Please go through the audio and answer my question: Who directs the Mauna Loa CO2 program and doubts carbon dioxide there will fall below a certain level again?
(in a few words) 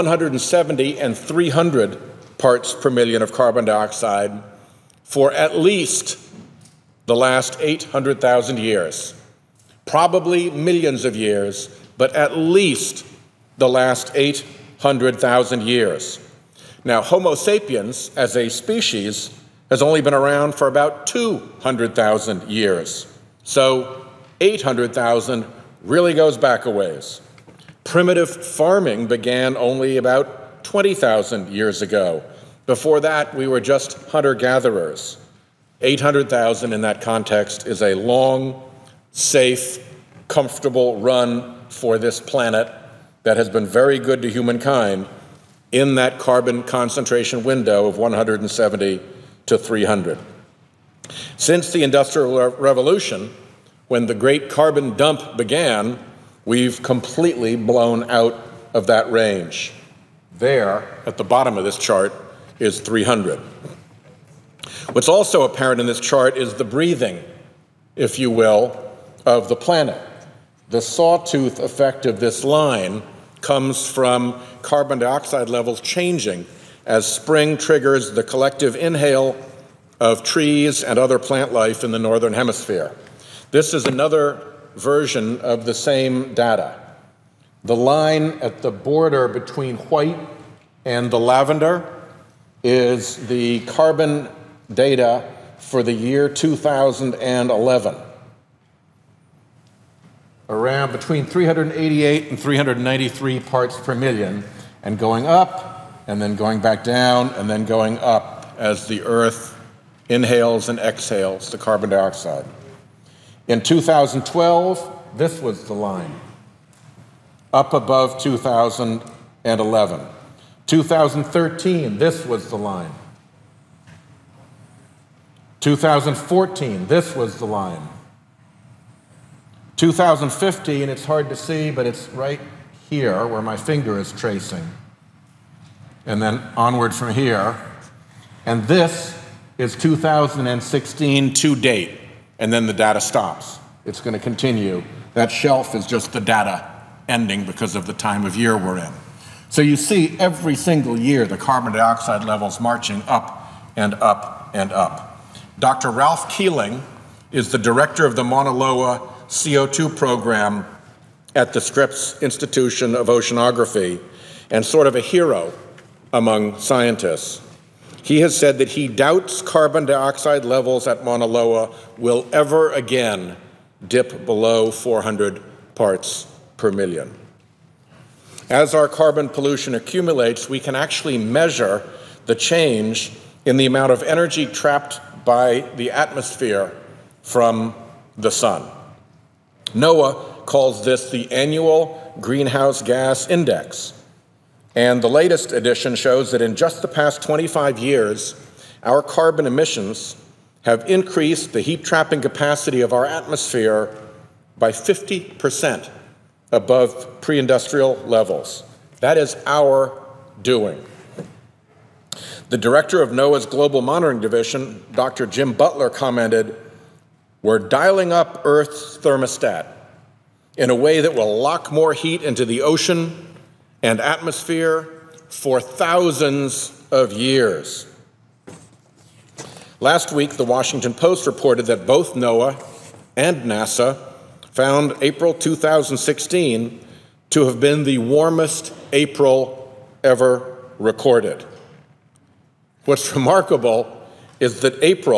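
Ralph Keeling.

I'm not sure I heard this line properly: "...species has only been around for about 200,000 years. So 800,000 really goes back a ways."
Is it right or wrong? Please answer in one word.
right.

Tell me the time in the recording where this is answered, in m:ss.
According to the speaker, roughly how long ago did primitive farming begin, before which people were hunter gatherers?
0:30.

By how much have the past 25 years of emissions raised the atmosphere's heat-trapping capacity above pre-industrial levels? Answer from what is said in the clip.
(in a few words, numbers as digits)
50%.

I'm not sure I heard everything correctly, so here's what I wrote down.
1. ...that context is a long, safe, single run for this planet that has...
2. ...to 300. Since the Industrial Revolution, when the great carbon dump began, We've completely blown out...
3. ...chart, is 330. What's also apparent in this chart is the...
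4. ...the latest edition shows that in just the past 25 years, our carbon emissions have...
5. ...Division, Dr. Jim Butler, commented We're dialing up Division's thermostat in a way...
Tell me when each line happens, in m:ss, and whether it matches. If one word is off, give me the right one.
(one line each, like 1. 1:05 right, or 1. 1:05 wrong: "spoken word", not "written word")
1. 0:36 wrong: "comfortable", not "single"
2. 0:49 right
3. 1:01 wrong: "300", not "330"
4. 3:15 right
5. 3:34 wrong: "Earth", not "Division".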